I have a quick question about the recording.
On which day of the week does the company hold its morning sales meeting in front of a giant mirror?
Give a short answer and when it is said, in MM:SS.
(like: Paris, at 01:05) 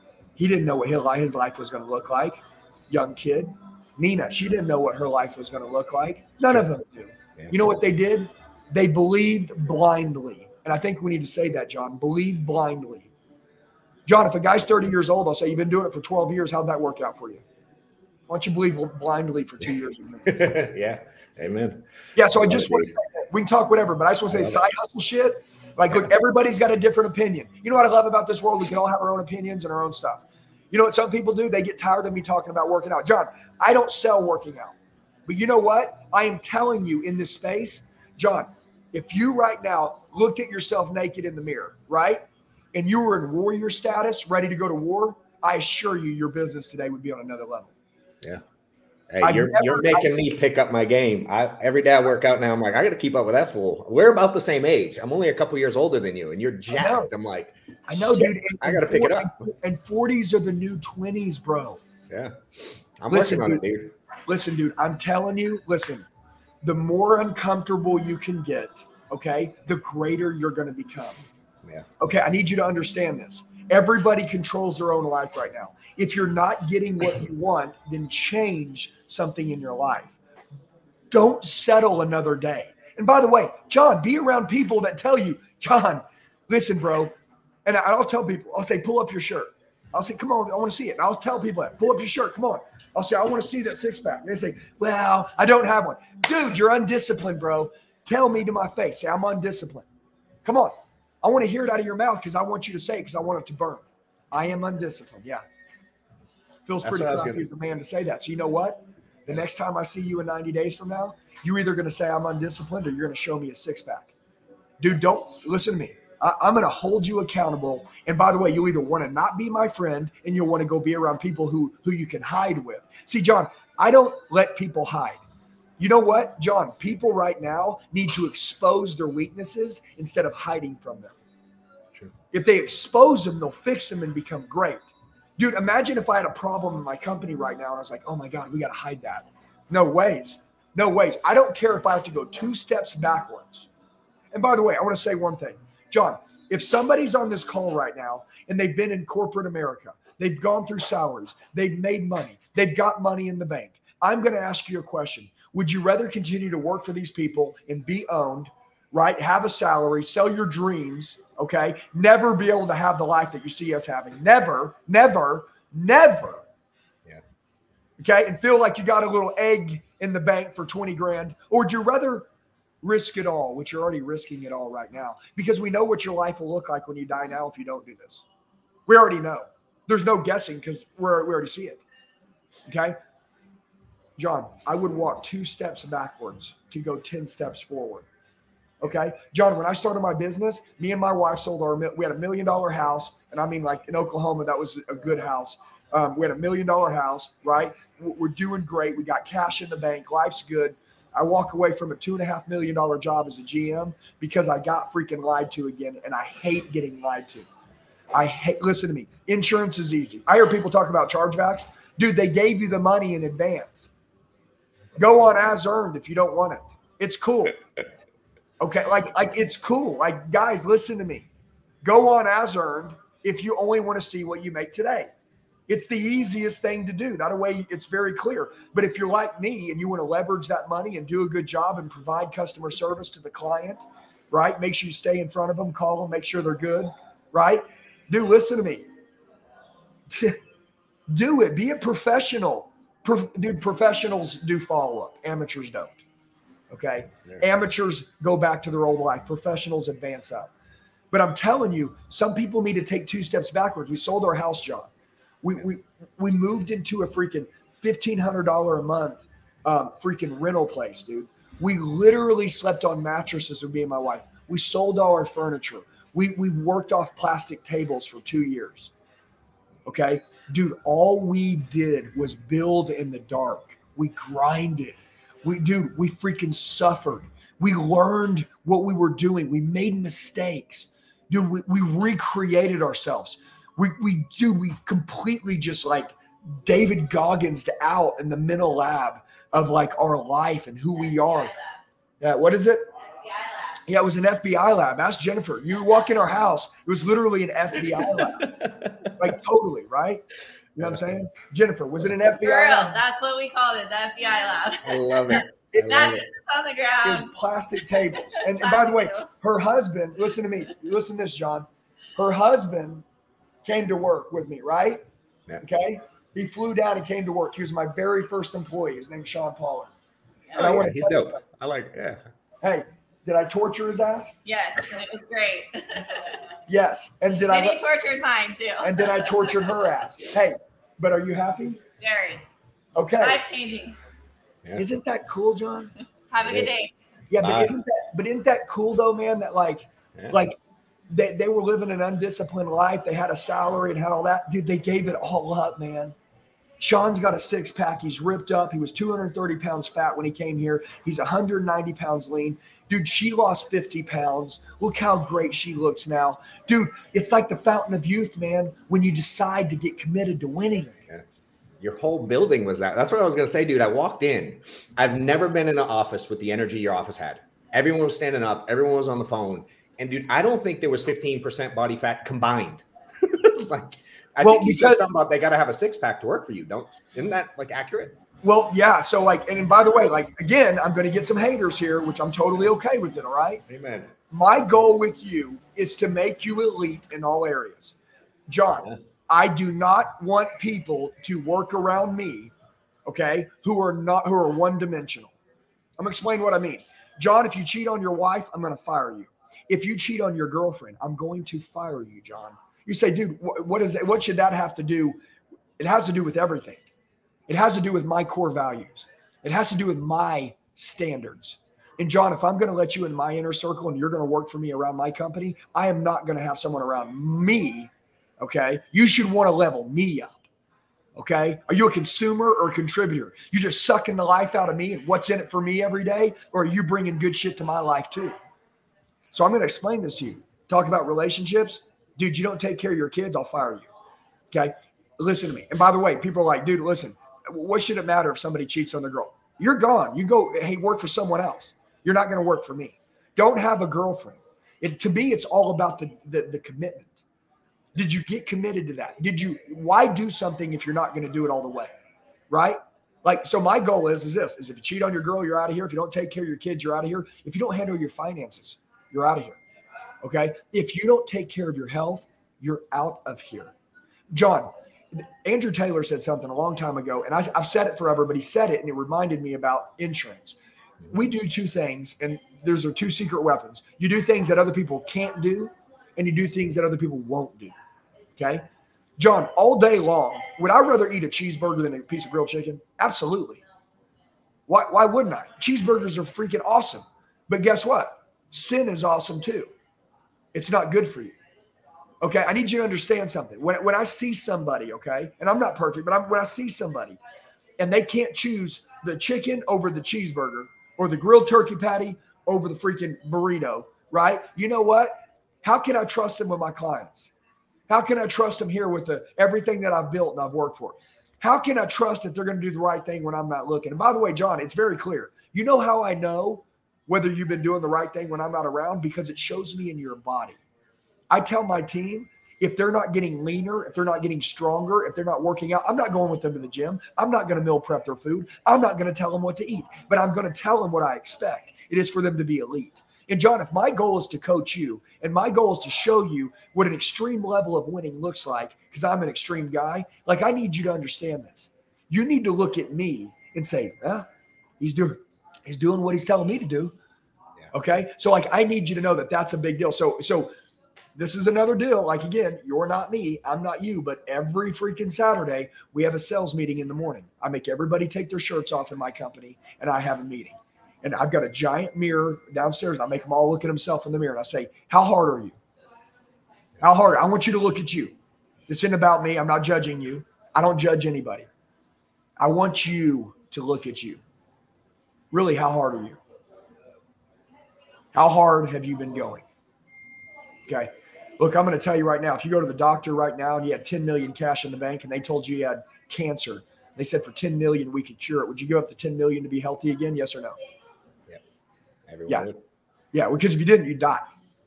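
Saturday, at 09:15.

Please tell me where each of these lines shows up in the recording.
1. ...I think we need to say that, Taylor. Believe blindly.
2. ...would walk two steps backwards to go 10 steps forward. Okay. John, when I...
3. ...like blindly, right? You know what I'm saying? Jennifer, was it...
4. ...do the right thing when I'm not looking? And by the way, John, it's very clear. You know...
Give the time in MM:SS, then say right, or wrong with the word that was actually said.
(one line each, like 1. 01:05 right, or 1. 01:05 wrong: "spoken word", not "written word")
1. 00:10 wrong: "John", not "Taylor"
2. 03:04 right
3. 04:59 wrong: "totally", not "blindly"
4. 08:32 right.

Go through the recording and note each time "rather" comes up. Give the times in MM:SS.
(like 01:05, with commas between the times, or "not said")
02:35, 02:51, 08:00.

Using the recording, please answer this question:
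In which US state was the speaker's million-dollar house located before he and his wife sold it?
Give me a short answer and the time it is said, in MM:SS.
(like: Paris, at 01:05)
Oklahoma, at 03:13.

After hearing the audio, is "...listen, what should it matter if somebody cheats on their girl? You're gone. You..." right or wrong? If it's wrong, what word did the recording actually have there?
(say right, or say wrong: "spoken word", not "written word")
right.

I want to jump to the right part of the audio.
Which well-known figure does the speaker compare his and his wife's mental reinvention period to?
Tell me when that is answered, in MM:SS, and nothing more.
04:46.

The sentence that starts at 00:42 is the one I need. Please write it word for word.
And you were in warrior status, ready to go to war, I assure you your business today would be on another level.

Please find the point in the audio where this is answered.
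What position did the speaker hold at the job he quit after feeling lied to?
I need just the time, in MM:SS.
03:23.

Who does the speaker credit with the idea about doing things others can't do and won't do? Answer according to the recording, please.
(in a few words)
Andrew Taylor.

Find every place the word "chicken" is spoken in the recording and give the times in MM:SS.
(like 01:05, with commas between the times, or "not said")
08:02, 08:19.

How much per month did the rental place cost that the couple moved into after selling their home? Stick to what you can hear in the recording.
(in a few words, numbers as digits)
$1,500.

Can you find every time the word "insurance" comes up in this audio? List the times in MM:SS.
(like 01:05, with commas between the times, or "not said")
03:29, 07:49.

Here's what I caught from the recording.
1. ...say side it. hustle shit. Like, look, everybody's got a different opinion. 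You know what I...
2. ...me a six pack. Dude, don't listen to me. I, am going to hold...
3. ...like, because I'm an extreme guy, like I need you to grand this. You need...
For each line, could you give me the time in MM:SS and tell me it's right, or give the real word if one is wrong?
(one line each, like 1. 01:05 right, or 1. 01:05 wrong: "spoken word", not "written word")
1. 00:24 right
2. 01:53 right
3. 08:58 wrong: "understand", not "grand".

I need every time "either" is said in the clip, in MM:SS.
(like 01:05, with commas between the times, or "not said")
01:51, 01:58.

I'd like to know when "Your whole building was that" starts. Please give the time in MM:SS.
06:01.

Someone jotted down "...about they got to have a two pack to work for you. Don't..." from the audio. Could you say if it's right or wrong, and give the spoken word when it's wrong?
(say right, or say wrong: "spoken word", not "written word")
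wrong: "six", not "two".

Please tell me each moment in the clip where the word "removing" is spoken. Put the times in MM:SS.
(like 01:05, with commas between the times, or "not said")
not said.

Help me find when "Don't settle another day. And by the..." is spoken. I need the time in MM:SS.
01:21.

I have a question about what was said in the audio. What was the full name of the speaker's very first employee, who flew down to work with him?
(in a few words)
Sean Pollard.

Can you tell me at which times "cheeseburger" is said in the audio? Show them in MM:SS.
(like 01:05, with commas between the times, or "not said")
08:01, 08:05, 08:20.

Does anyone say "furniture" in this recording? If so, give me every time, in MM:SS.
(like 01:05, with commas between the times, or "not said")
04:25.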